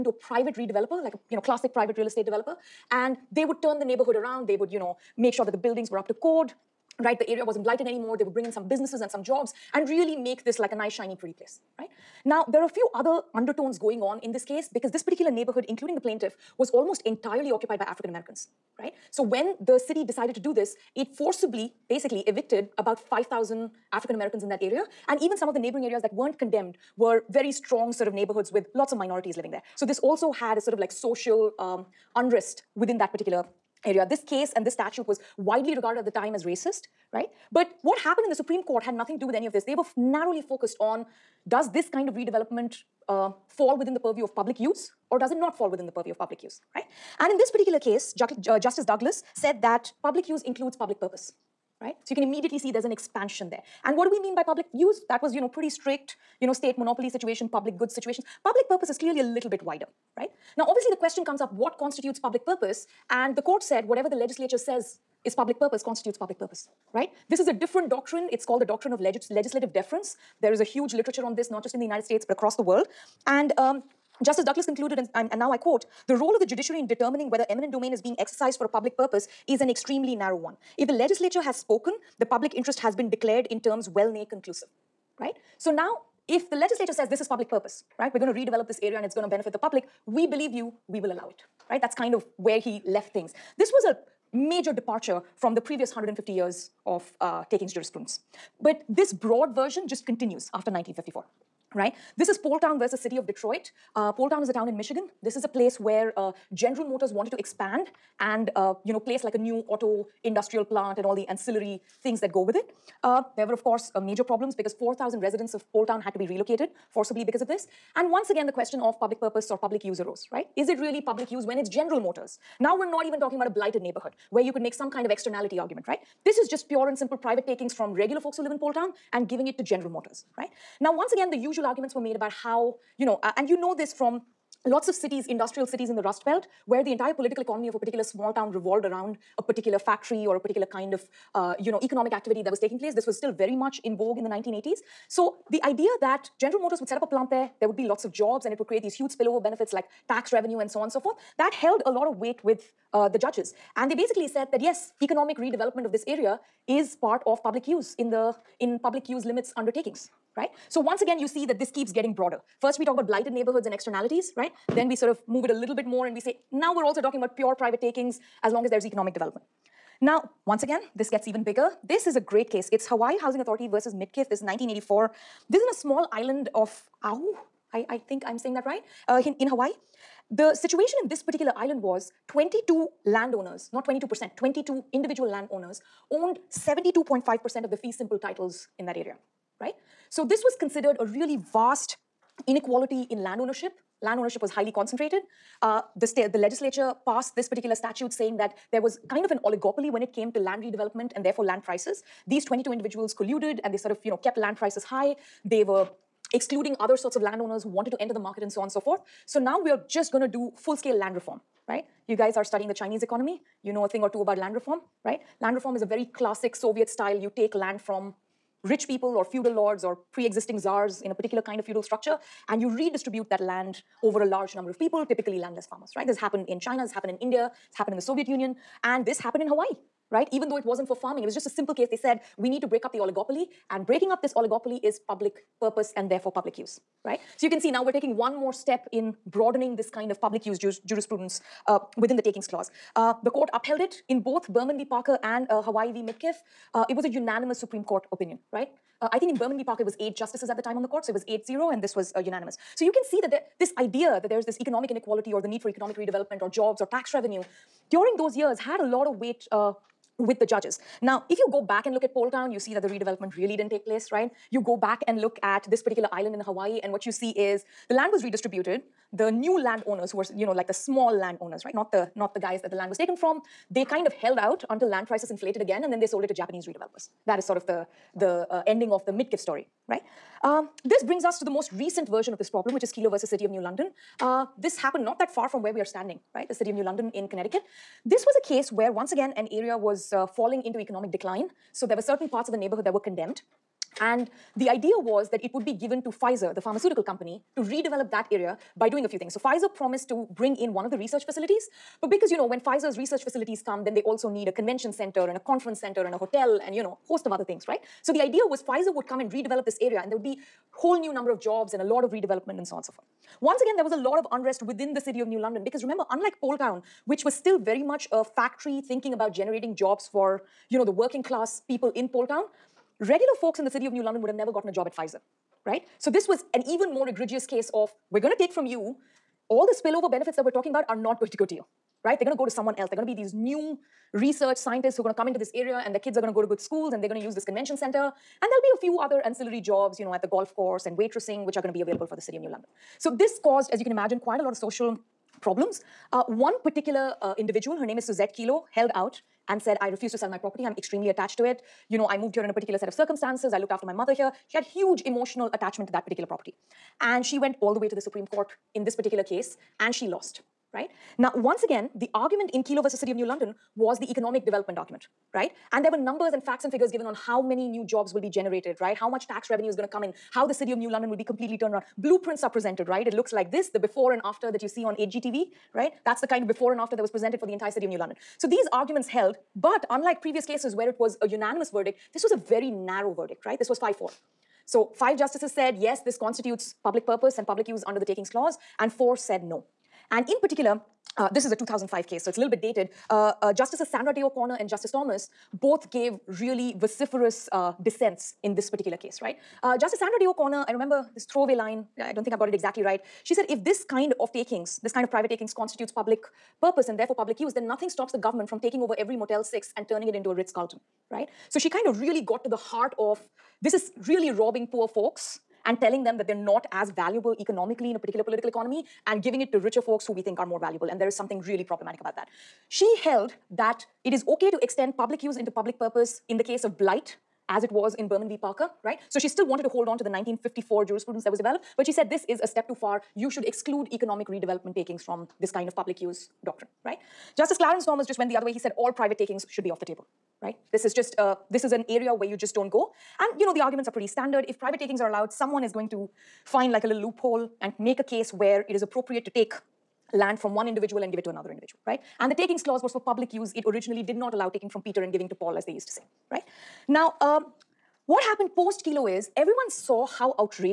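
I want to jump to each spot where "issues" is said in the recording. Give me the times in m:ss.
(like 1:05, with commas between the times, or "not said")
not said.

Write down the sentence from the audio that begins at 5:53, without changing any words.
I looked after my mother here.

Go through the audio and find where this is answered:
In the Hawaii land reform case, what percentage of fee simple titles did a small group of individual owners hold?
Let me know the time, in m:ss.
3:06.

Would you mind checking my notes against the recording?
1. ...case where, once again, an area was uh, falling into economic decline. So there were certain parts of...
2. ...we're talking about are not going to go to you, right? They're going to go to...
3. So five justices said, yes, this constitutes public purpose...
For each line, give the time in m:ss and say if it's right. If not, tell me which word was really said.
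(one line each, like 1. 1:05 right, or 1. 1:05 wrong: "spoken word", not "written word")
1. 4:48 right
2. 5:30 right
3. 6:24 right.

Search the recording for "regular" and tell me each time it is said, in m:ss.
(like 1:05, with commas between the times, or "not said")
2:07, 5:23.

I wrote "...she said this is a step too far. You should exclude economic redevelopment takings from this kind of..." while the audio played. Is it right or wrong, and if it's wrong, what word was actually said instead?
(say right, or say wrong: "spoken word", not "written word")
right.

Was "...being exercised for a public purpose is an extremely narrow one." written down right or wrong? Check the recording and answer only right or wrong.
right.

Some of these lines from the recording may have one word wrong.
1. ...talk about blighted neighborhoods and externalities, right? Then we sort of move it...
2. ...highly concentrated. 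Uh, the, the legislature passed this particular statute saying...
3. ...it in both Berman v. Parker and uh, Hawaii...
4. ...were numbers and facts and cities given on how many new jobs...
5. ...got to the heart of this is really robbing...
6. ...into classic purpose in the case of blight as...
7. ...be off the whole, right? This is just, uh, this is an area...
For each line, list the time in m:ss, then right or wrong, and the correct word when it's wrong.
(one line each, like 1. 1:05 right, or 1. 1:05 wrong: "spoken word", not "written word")
1. 2:42 right
2. 3:14 right
3. 4:03 right
4. 6:05 wrong: "figures", not "cities"
5. 6:52 right
6. 7:05 wrong: "public", not "classic"
7. 7:19 wrong: "table", not "whole".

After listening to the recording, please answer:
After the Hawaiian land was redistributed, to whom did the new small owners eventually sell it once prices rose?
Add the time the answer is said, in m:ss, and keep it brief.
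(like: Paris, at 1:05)
Japanese redevelopers, at 4:36.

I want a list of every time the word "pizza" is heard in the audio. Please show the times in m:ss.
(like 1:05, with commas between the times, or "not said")
not said.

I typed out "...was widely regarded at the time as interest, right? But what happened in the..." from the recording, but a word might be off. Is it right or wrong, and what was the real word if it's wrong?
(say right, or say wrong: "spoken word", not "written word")
wrong: "racist", not "interest".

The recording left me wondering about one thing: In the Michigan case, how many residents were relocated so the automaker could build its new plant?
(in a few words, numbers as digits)
4,000.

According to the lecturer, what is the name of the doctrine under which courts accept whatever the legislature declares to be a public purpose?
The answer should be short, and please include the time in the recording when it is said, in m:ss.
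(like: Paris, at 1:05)
legislative deference, at 1:09.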